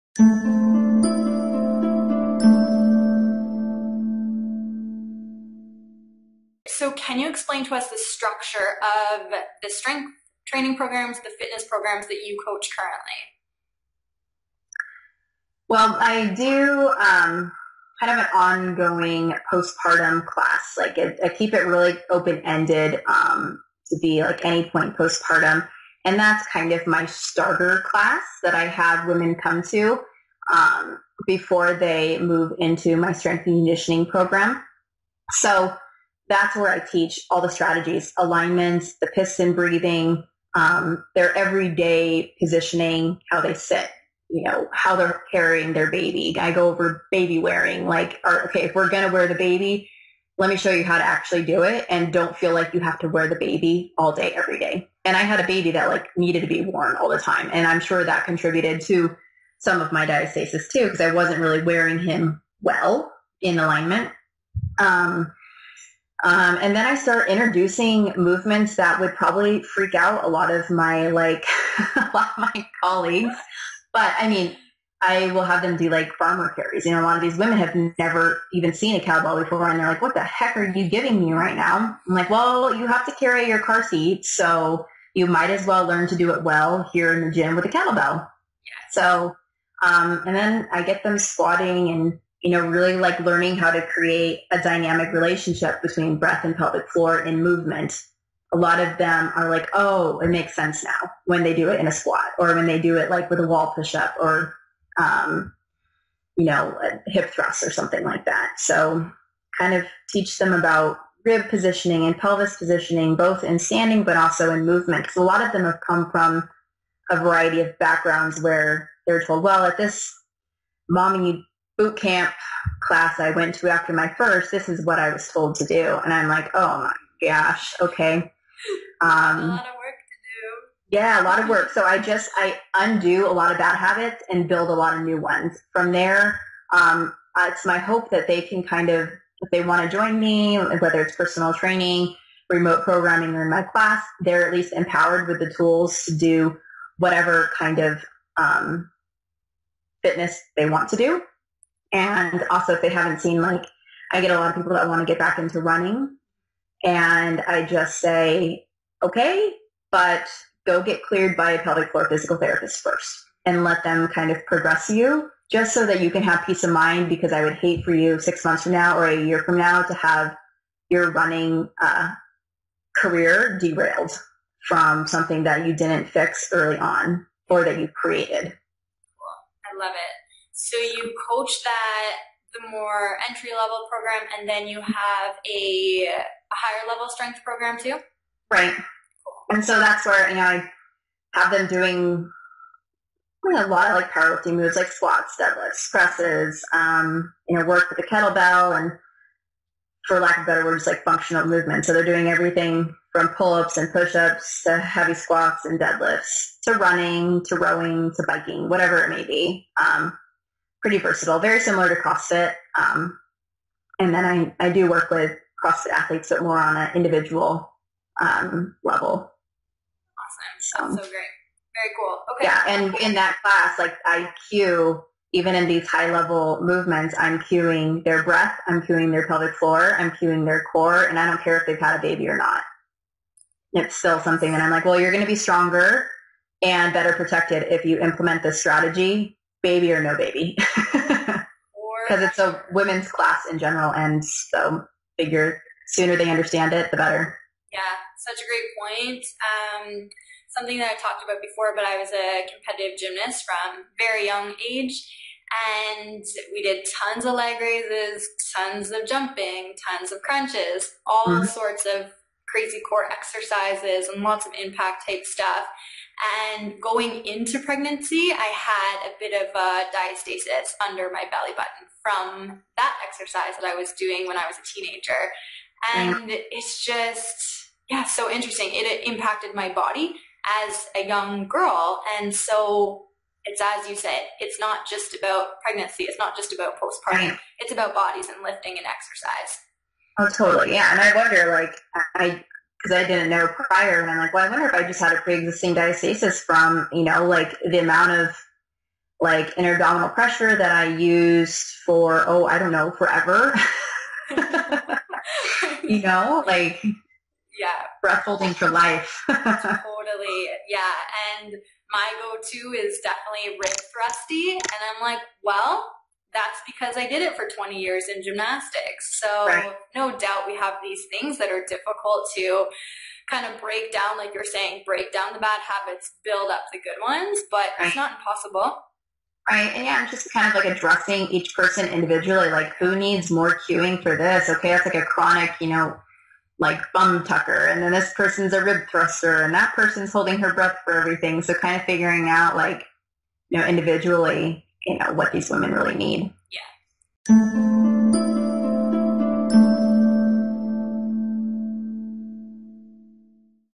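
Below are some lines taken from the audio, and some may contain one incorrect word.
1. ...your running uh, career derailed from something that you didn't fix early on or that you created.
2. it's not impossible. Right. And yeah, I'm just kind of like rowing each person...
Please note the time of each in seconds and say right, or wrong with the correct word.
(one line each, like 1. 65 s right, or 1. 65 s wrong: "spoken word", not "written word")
1. 170 s right
2. 327 s wrong: "addressing", not "rowing".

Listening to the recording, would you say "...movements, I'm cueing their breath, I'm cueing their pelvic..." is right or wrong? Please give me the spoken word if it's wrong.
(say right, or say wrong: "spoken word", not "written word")
right.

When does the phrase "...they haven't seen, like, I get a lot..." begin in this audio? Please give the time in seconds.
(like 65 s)
152 s.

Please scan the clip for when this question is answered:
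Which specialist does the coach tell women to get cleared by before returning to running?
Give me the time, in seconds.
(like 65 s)
161 s.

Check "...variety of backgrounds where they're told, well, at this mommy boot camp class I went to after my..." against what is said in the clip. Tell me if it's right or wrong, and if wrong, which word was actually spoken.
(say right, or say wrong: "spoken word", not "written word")
right.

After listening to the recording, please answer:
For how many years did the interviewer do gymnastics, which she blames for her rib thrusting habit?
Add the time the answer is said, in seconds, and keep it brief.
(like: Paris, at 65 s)
20, at 317 s.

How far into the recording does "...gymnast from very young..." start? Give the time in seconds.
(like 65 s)
252 s.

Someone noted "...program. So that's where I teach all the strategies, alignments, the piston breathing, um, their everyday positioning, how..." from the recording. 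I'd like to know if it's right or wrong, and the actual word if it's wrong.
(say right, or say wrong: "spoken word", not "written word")
right.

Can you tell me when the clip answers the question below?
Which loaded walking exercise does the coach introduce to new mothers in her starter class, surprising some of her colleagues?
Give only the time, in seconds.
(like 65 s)
76 s.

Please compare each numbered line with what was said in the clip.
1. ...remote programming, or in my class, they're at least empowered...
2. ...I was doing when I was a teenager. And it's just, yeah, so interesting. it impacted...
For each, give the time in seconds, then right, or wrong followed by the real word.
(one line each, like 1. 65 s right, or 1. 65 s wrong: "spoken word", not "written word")
1. 142 s right
2. 273 s right.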